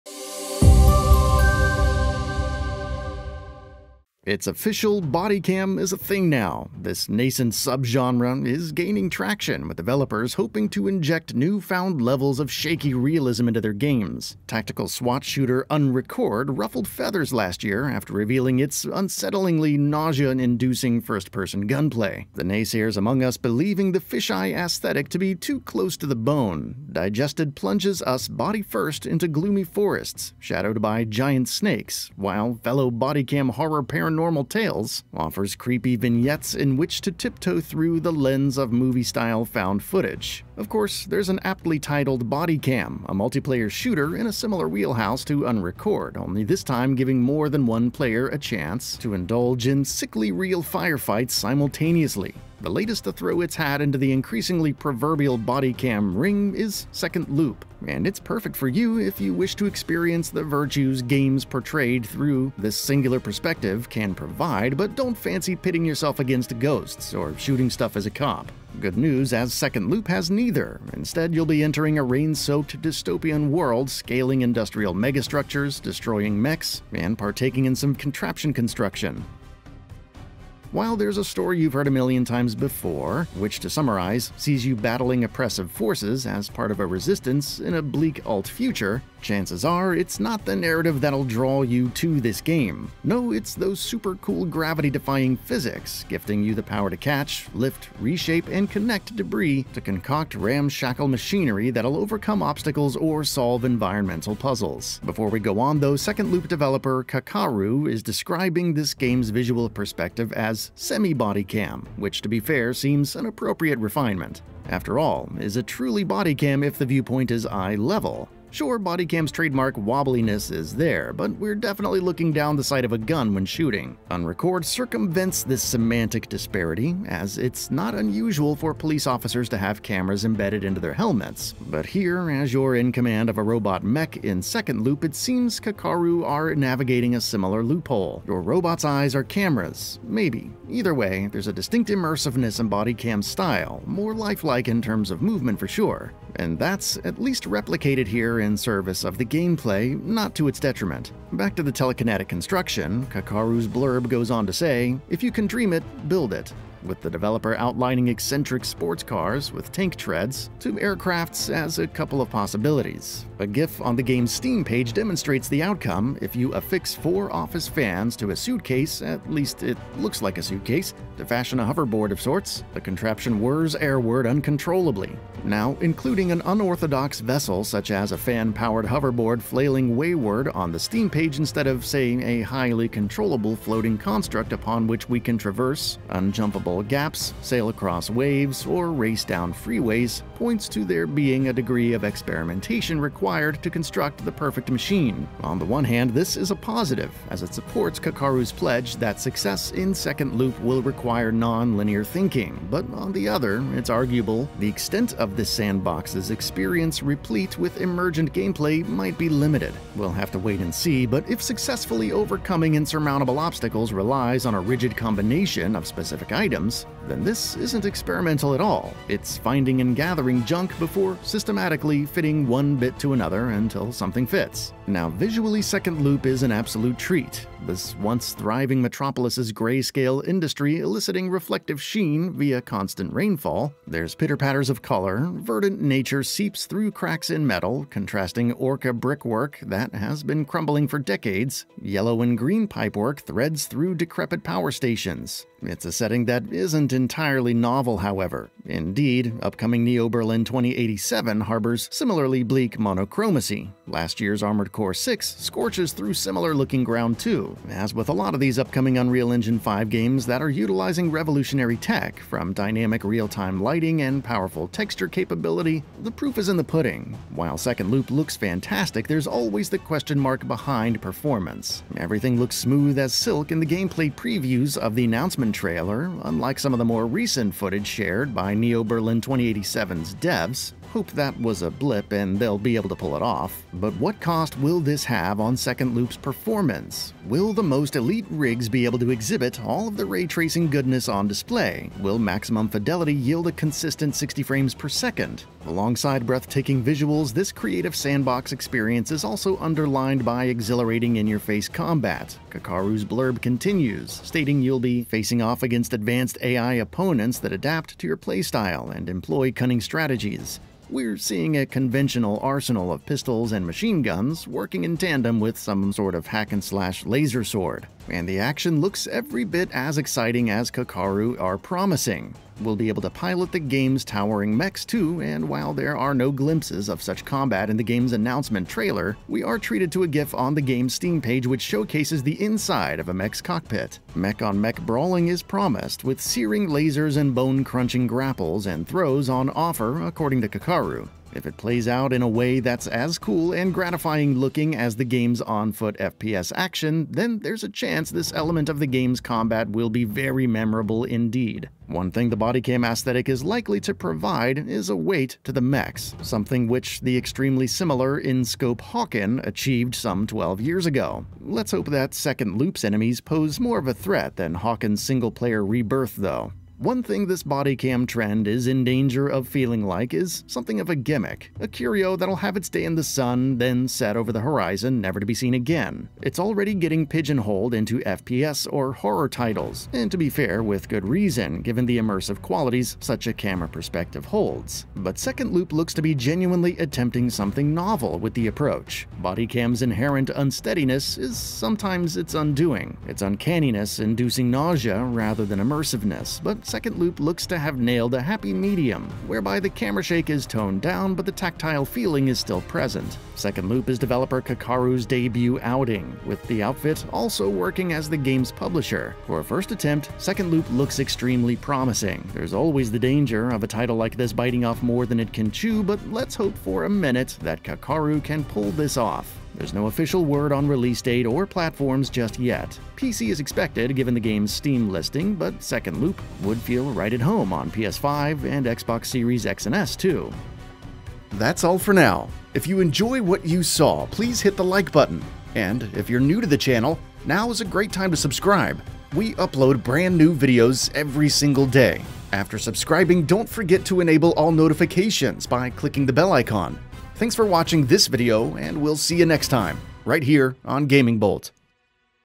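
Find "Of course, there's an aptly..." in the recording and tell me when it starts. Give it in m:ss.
0:40.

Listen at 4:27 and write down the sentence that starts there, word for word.
While Second Loop looks fantastic, there's always the question mark behind performance.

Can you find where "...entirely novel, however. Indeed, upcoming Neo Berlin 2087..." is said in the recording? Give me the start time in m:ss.
4:06.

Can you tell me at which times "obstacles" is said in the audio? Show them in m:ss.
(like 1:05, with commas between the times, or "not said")
1:42, 3:33.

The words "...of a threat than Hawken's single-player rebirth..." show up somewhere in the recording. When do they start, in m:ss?
6:03.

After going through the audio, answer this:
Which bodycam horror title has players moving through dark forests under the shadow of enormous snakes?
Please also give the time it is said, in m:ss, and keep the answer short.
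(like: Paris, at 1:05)
Digested, at 0:26.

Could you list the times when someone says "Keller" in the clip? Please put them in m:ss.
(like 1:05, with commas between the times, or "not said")
not said.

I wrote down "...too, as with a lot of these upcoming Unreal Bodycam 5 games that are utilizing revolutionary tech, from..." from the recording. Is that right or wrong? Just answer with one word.
wrong.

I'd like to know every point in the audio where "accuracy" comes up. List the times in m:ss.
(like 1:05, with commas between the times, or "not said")
not said.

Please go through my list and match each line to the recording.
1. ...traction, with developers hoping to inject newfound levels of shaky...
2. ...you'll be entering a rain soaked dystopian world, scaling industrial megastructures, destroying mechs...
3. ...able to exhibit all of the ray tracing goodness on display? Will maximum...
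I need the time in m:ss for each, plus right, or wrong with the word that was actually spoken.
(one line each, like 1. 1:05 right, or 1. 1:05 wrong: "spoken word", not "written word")
1. 0:09 right
2. 1:11 right
3. 4:48 right.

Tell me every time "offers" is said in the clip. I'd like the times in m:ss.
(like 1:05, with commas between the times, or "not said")
0:35, 5:39.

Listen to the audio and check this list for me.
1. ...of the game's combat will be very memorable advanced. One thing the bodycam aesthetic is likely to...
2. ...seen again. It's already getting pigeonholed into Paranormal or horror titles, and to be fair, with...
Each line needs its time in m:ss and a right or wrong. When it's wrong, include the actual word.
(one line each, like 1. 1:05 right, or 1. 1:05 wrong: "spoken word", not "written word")
1. 5:48 wrong: "indeed", not "advanced"
2. 6:15 wrong: "FPS", not "Paranormal".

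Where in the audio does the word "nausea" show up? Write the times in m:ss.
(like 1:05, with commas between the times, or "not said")
0:19, 6:34.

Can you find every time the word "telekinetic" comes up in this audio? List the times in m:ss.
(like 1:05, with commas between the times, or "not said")
2:31.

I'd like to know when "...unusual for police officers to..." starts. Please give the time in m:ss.
2:07.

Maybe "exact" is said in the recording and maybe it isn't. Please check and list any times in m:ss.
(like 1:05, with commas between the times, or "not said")
not said.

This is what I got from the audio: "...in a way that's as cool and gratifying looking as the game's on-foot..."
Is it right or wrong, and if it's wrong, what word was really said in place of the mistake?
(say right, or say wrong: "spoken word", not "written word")
right.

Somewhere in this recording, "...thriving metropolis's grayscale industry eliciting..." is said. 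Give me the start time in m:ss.
3:48.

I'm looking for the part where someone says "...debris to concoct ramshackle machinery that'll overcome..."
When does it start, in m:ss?
1:39.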